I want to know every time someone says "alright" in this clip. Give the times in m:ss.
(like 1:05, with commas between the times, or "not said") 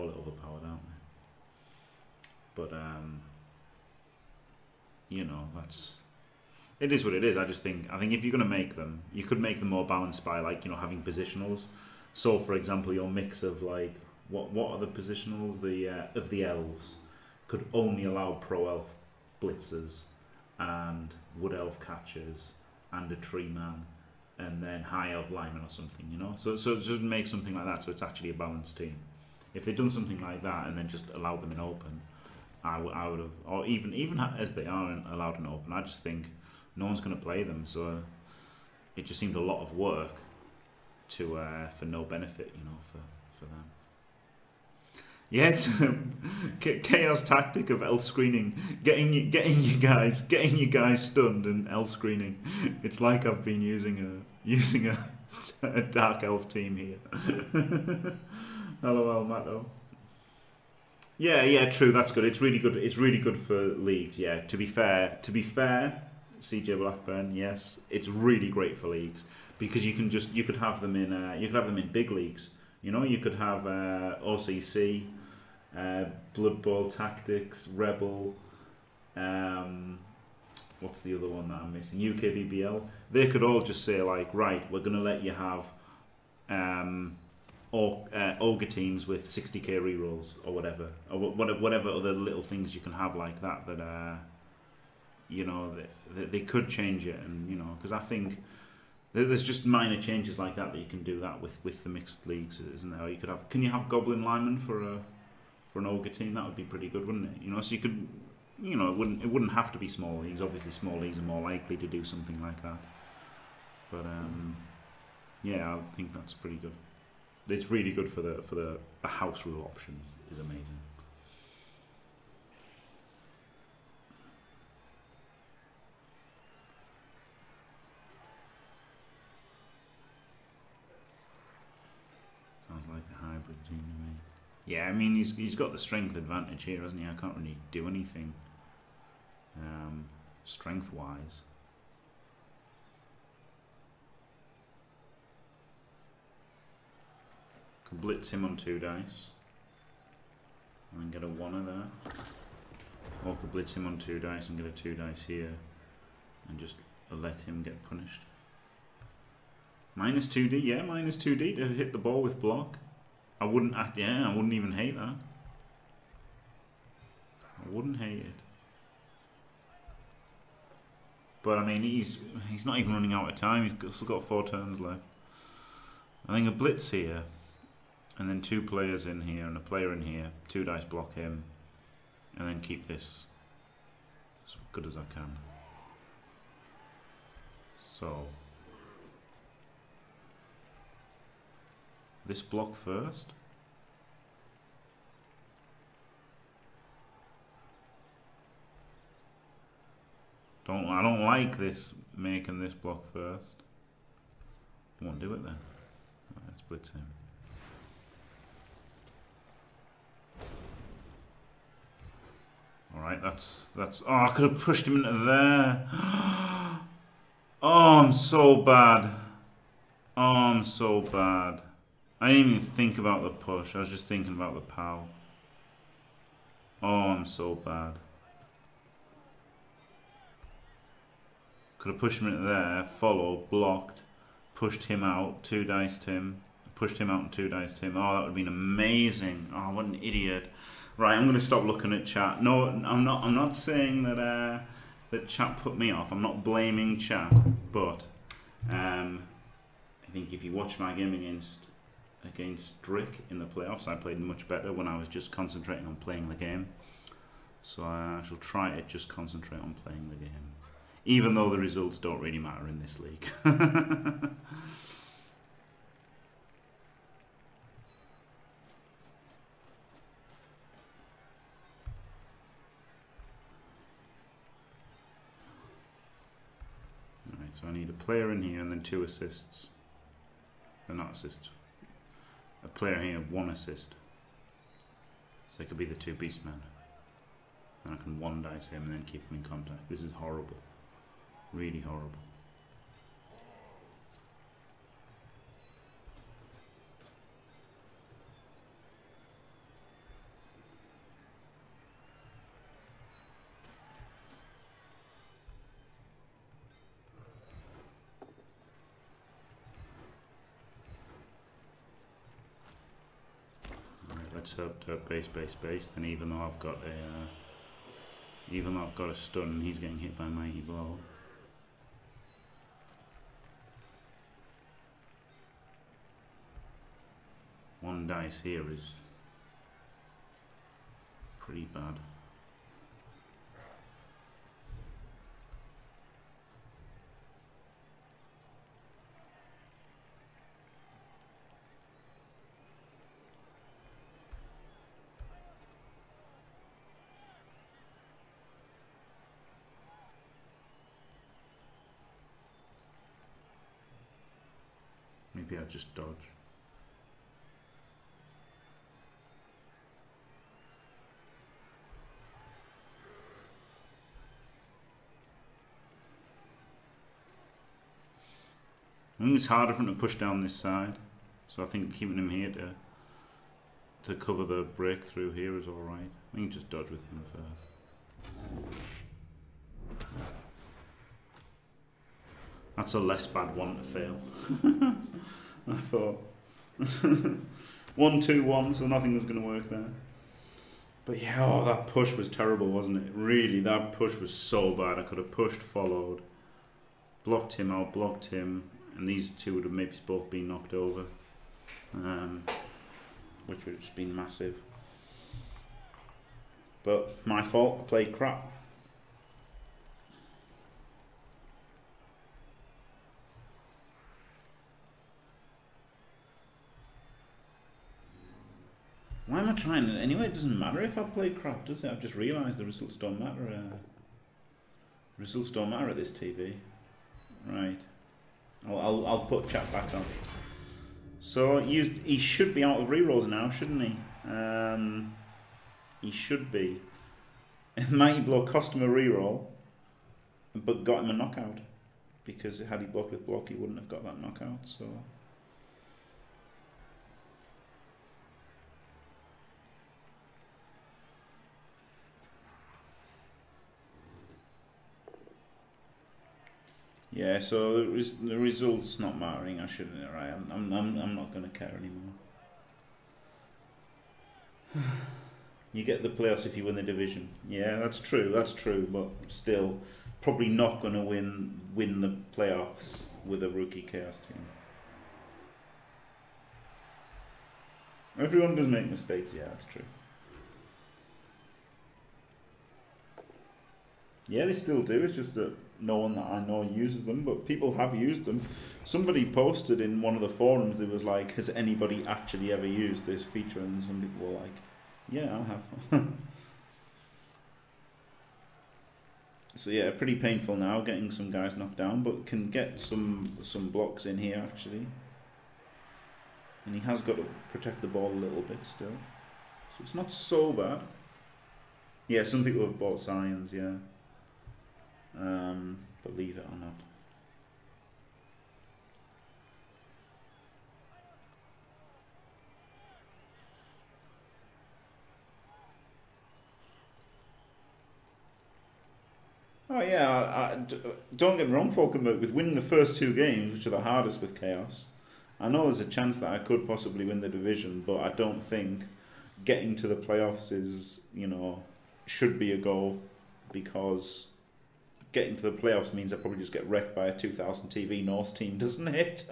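3:32, 6:15.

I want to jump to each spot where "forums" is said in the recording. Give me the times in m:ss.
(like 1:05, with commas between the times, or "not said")
8:10.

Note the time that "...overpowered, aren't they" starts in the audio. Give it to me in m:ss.
0:00.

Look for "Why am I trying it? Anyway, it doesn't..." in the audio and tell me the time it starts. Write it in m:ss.
6:59.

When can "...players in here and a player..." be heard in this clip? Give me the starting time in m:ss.
2:58.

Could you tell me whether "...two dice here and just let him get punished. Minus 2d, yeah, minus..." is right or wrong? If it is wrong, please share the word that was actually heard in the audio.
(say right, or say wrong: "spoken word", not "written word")
right.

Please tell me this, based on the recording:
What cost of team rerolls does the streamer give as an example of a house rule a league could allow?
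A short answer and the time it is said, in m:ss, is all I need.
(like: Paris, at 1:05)
60k, at 1:29.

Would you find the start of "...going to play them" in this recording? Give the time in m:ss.
0:37.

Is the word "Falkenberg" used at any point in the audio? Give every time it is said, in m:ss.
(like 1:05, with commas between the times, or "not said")
8:51.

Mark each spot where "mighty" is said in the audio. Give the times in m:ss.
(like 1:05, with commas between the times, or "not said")
5:20, 7:17.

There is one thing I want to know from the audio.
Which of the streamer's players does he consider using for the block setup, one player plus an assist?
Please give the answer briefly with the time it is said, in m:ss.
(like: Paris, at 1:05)
The two beastmen, at 4:45.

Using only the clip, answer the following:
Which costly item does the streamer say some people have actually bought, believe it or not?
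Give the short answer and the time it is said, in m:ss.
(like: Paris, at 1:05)
Scions, at 8:33.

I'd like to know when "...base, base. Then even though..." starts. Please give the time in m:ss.
5:15.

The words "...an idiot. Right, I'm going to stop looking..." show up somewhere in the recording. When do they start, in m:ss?
3:59.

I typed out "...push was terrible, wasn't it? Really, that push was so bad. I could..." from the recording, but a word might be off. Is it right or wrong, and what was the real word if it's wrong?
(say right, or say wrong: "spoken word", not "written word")
right.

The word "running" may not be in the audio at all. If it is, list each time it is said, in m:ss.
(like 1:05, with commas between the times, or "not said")
2:52.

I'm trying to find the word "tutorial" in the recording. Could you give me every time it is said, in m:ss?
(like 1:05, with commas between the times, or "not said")
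not said.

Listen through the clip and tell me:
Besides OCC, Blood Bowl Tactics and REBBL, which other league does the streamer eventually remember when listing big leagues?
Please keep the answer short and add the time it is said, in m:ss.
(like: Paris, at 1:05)
UKBBL, at 1:21.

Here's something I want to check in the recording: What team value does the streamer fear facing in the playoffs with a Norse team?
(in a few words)
2000.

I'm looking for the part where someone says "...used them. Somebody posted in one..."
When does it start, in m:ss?
8:07.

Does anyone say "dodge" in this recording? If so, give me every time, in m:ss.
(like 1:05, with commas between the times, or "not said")
5:55, 6:16.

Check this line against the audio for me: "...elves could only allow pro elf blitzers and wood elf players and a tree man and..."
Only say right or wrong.
wrong.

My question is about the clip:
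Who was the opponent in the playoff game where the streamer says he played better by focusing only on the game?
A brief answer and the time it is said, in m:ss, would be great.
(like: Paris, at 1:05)
Drick, at 4:12.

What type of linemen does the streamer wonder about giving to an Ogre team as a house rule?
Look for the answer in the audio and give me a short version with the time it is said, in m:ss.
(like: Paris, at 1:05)
Goblin linemen, at 1:43.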